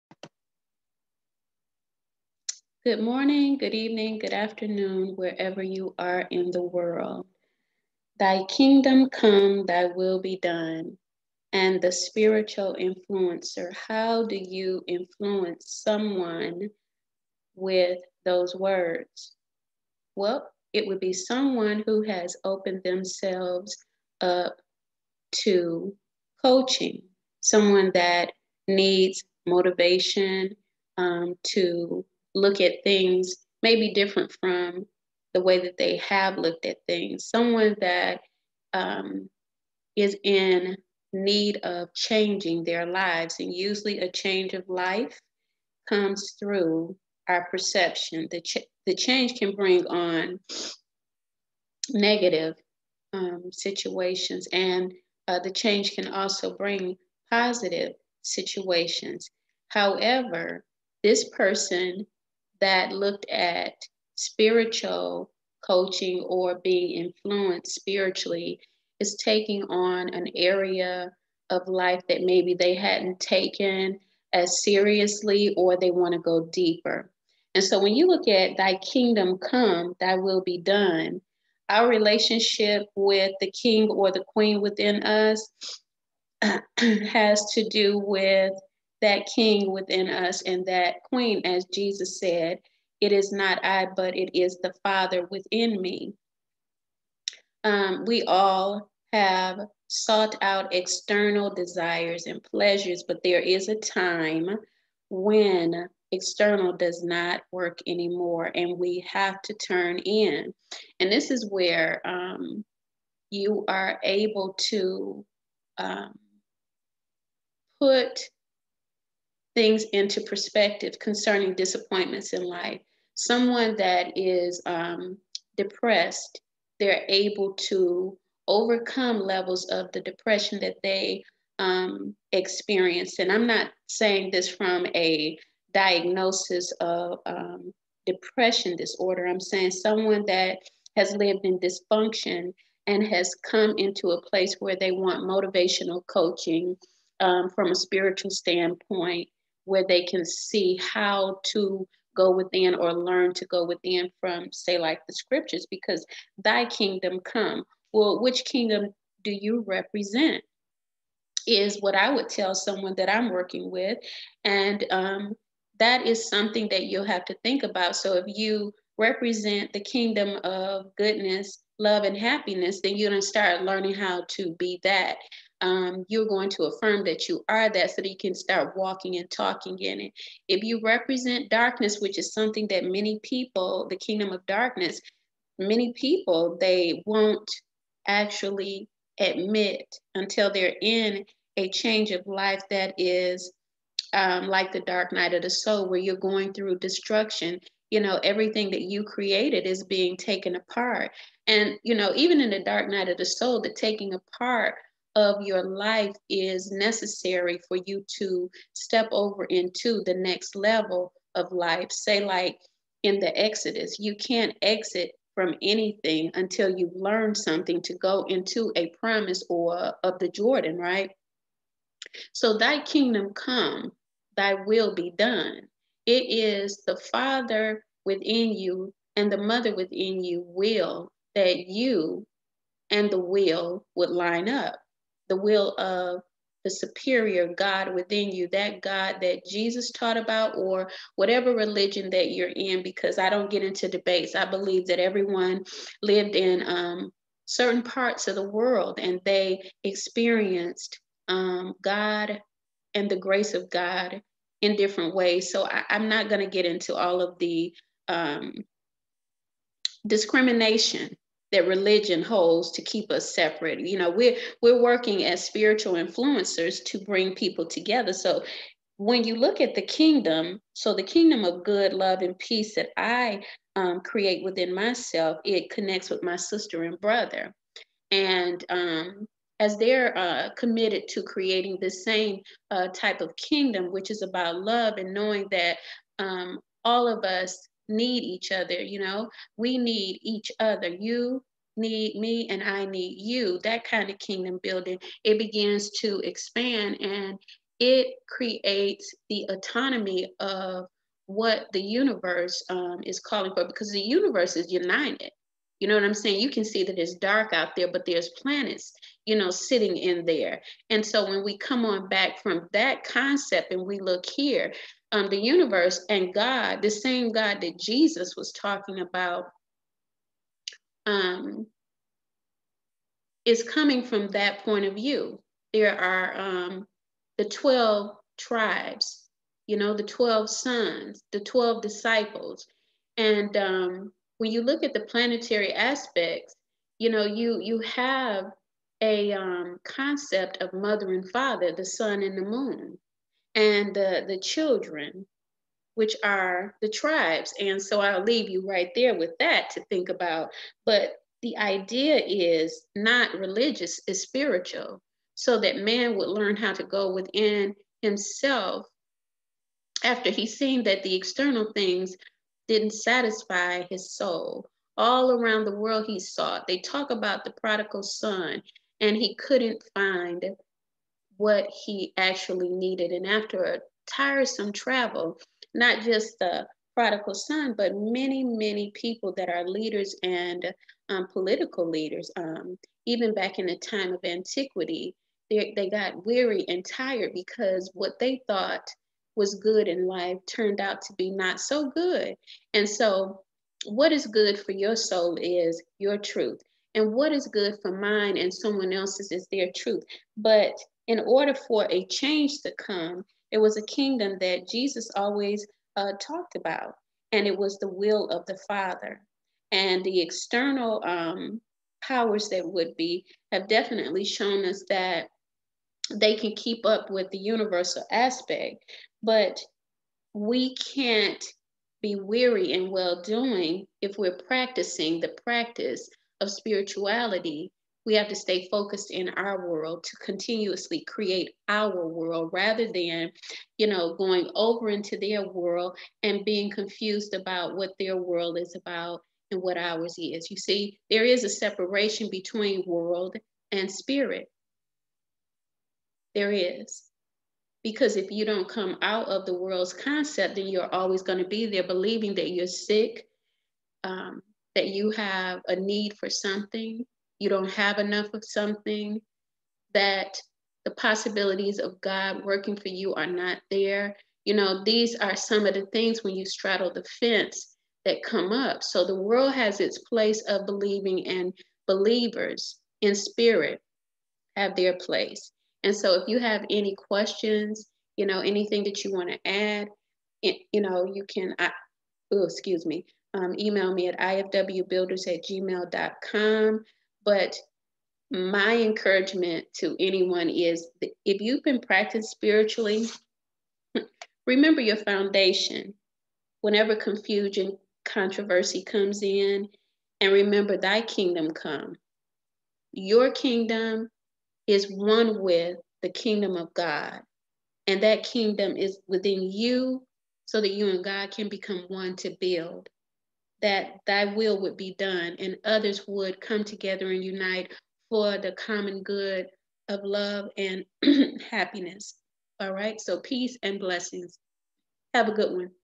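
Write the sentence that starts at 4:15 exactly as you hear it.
So I, am not going to get into all of the um, discrimination that religion holds to keep us separate.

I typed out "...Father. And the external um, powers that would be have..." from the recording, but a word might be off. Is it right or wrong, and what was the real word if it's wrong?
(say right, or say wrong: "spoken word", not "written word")
right.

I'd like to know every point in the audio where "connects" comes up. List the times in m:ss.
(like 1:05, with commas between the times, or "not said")
4:35.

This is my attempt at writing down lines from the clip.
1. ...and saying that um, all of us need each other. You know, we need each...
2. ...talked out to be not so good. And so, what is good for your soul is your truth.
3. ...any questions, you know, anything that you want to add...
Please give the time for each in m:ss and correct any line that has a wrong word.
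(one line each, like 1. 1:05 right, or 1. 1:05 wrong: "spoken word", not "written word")
1. 4:44 wrong: "knowing", not "saying"
2. 6:30 wrong: "turned", not "talked"
3. 7:56 right.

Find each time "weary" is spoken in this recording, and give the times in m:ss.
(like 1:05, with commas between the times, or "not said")
6:26, 7:02.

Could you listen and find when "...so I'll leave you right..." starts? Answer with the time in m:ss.
5:47.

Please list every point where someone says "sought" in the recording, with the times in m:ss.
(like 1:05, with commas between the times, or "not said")
1:39, 6:06.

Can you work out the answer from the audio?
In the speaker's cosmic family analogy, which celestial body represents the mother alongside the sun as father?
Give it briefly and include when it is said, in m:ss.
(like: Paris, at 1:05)
The moon, at 5:42.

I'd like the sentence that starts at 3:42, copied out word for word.
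So, thy kingdom come, thy will be done.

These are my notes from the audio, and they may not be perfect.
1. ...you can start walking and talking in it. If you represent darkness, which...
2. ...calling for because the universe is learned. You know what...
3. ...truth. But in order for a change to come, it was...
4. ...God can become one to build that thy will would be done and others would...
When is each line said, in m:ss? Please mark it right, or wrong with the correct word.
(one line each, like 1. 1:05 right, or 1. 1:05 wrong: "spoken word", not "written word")
1. 2:58 right
2. 5:03 wrong: "united", not "learned"
3. 6:39 right
4. 8:31 right.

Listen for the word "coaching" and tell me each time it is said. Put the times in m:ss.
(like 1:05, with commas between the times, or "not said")
0:26, 1:05, 2:26.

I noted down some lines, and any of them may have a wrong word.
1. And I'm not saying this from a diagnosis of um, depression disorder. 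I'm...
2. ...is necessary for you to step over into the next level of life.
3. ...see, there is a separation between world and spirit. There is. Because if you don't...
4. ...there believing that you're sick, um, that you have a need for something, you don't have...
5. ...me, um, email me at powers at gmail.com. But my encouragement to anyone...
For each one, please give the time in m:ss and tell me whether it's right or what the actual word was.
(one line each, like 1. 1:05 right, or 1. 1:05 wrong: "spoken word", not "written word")
1. 2:13 right
2. 3:26 right
3. 7:20 right
4. 7:31 right
5. 8:02 wrong: "ifwbuilders", not "powers".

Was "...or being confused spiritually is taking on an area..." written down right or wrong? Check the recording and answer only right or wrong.
wrong.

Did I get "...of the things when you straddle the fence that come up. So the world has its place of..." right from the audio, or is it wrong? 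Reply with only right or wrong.
right.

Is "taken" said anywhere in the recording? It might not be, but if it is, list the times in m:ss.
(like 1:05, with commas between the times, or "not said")
1:13, 3:20.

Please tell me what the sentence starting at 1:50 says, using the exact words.
And this is where um, you are able to um, put things into perspective concerning disappointments in life.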